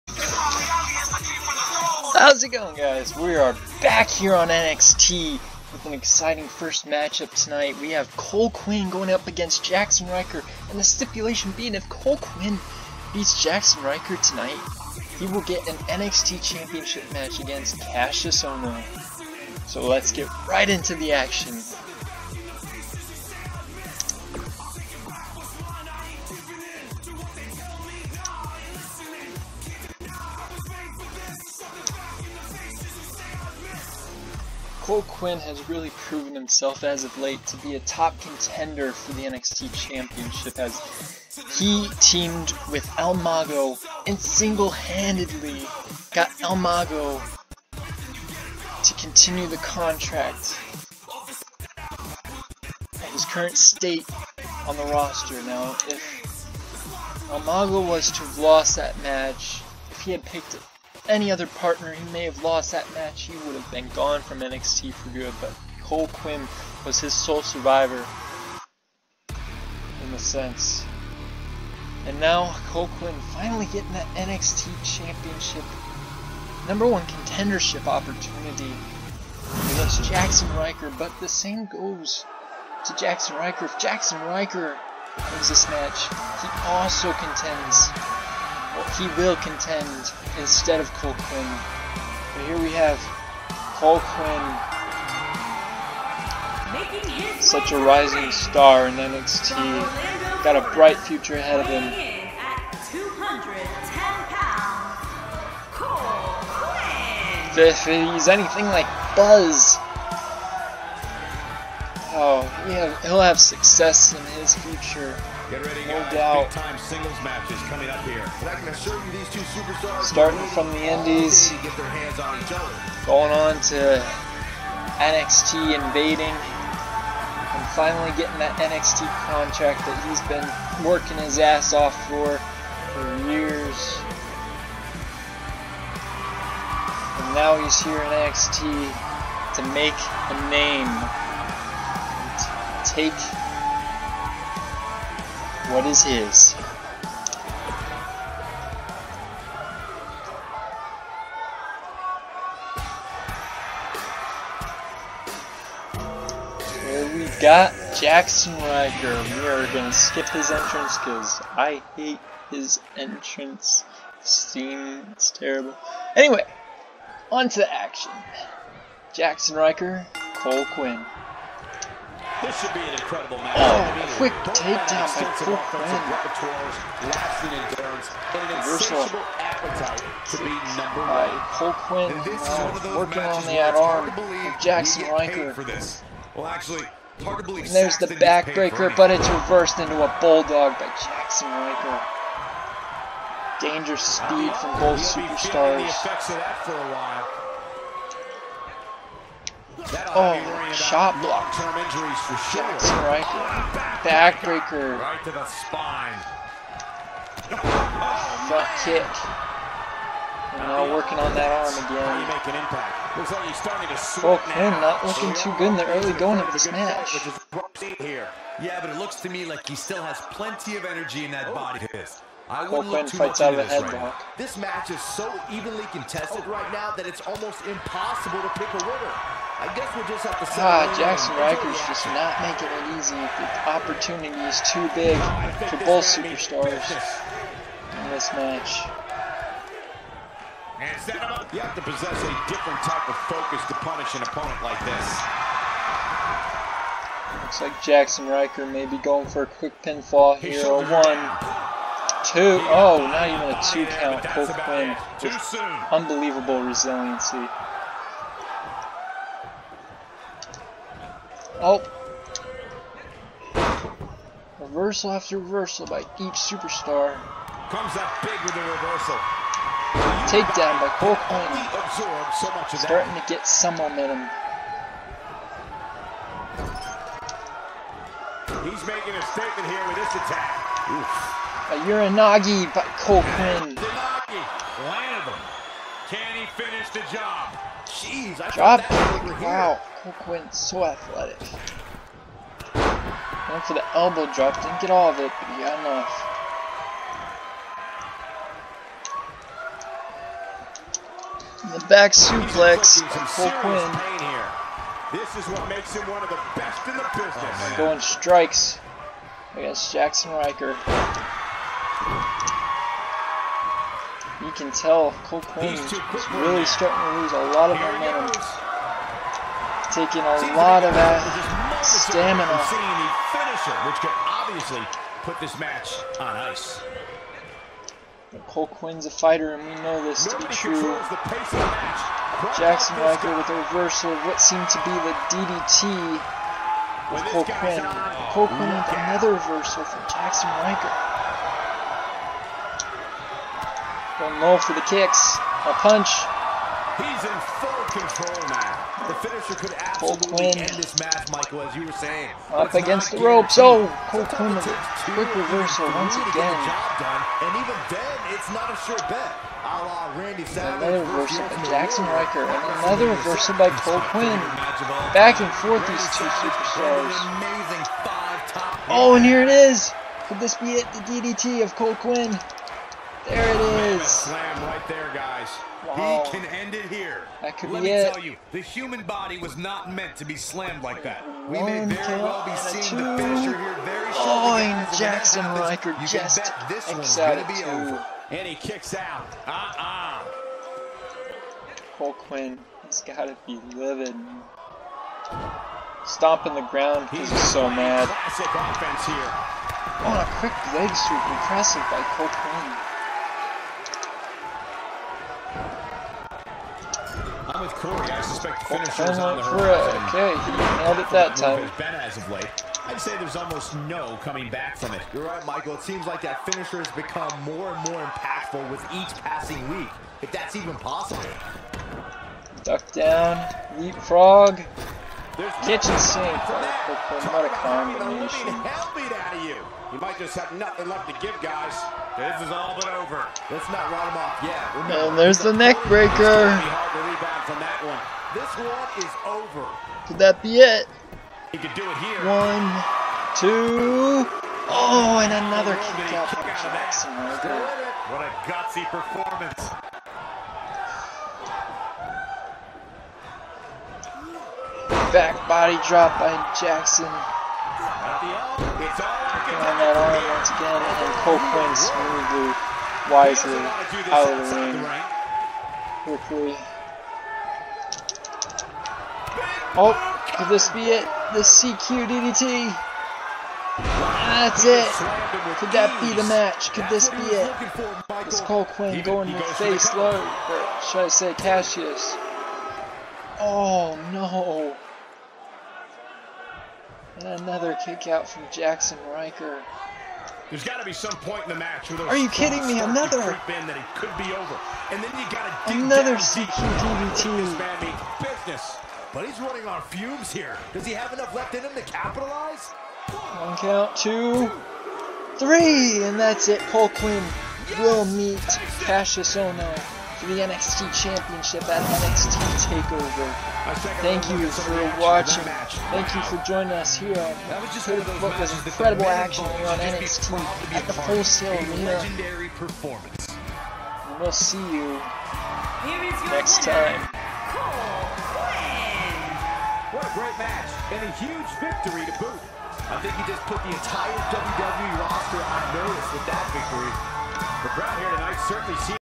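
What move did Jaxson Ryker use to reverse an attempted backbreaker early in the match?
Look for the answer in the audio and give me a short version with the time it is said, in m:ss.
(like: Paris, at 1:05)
bulldog, at 3:10.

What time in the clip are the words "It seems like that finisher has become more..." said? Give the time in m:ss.
6:55.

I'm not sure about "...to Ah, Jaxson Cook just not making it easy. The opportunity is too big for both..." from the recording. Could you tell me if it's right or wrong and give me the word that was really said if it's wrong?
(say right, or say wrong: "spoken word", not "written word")
wrong: "Rykers", not "Cook".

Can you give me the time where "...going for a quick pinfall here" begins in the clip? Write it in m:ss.
4:08.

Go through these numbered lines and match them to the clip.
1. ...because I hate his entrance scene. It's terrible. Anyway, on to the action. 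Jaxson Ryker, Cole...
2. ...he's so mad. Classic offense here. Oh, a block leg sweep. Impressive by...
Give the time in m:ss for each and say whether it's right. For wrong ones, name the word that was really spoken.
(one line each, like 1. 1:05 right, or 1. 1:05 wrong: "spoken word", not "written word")
1. 2:40 right
2. 6:37 wrong: "quick", not "block".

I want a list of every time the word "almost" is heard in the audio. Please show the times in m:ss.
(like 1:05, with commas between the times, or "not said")
3:47, 6:53.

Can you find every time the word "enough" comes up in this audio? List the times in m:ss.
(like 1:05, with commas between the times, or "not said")
4:55, 8:21.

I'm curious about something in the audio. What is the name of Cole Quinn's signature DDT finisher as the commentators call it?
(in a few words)
CQ DDT.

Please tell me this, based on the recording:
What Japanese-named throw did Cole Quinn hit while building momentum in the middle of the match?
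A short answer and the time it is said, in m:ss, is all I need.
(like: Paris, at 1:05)
Uranagi, at 4:41.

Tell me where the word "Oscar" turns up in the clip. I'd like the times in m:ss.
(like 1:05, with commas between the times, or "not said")
not said.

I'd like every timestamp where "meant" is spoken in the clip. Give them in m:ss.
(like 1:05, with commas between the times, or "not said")
6:19.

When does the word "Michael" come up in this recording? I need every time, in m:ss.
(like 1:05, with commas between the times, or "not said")
5:51, 6:55.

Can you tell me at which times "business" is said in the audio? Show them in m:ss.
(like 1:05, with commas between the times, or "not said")
5:07, 8:18.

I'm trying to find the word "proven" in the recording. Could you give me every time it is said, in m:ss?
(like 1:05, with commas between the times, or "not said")
0:35.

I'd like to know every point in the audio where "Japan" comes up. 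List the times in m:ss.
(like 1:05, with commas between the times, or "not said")
not said.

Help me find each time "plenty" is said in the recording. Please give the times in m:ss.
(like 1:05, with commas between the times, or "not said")
3:40.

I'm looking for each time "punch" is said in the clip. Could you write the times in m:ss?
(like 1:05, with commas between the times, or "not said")
5:45.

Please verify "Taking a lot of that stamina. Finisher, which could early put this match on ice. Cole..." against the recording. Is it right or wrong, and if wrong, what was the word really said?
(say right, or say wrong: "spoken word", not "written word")
wrong: "obviously", not "early".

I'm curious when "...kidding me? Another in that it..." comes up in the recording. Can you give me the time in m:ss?
8:12.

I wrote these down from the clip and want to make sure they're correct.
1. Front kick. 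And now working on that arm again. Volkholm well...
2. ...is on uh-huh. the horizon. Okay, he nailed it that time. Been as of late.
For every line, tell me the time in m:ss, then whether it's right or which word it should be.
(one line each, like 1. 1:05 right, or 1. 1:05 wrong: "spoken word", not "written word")
1. 3:28 right
2. 6:49 right.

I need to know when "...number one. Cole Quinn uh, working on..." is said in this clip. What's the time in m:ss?
3:00.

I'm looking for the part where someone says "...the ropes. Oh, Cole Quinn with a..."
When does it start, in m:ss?
5:53.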